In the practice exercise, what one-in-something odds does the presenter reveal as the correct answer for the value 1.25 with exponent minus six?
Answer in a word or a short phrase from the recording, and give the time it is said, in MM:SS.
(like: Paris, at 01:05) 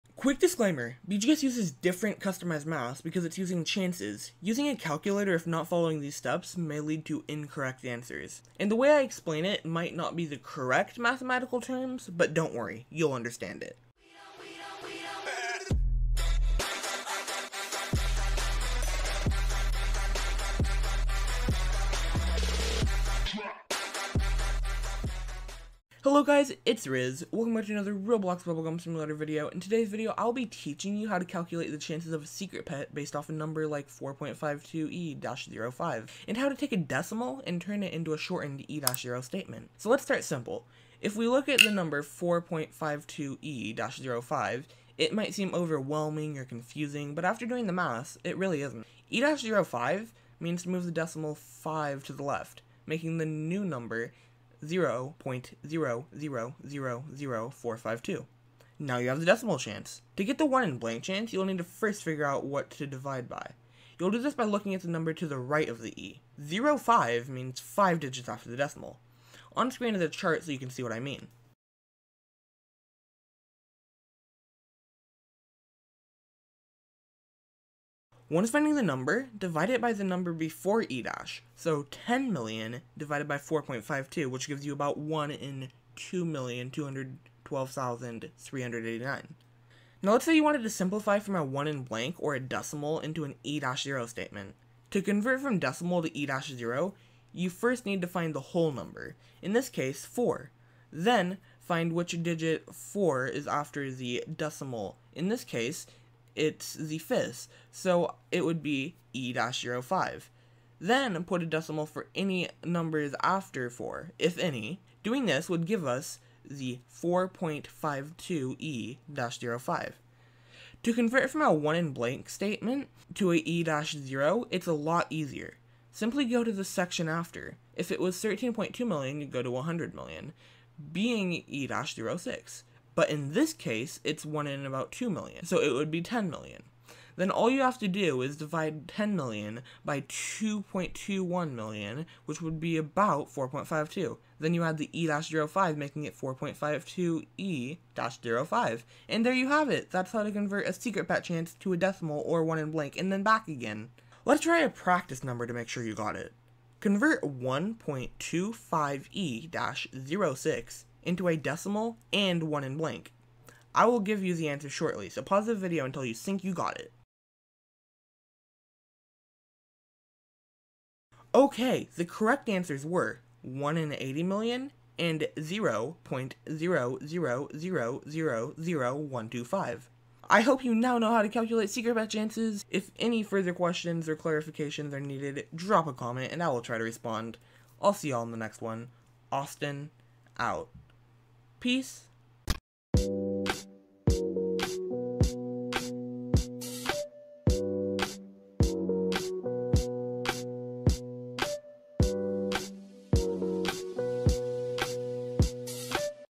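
1 in 80 million, at 02:53.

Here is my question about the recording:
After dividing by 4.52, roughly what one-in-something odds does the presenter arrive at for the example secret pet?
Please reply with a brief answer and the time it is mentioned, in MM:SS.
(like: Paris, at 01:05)
1 in 2,212,389, at 01:24.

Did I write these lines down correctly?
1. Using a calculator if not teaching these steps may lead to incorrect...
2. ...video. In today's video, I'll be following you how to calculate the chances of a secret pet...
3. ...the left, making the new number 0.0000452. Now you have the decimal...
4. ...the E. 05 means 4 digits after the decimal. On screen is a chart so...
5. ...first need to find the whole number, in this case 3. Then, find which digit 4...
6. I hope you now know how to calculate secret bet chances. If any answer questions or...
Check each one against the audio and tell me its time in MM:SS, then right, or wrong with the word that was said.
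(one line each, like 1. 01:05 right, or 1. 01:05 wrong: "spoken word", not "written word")
1. 00:04 wrong: "following", not "teaching"
2. 00:29 wrong: "teaching", not "following"
3. 00:52 right
4. 01:05 wrong: "5", not "4"
5. 01:37 wrong: "4", not "3"
6. 03:00 wrong: "further", not "answer".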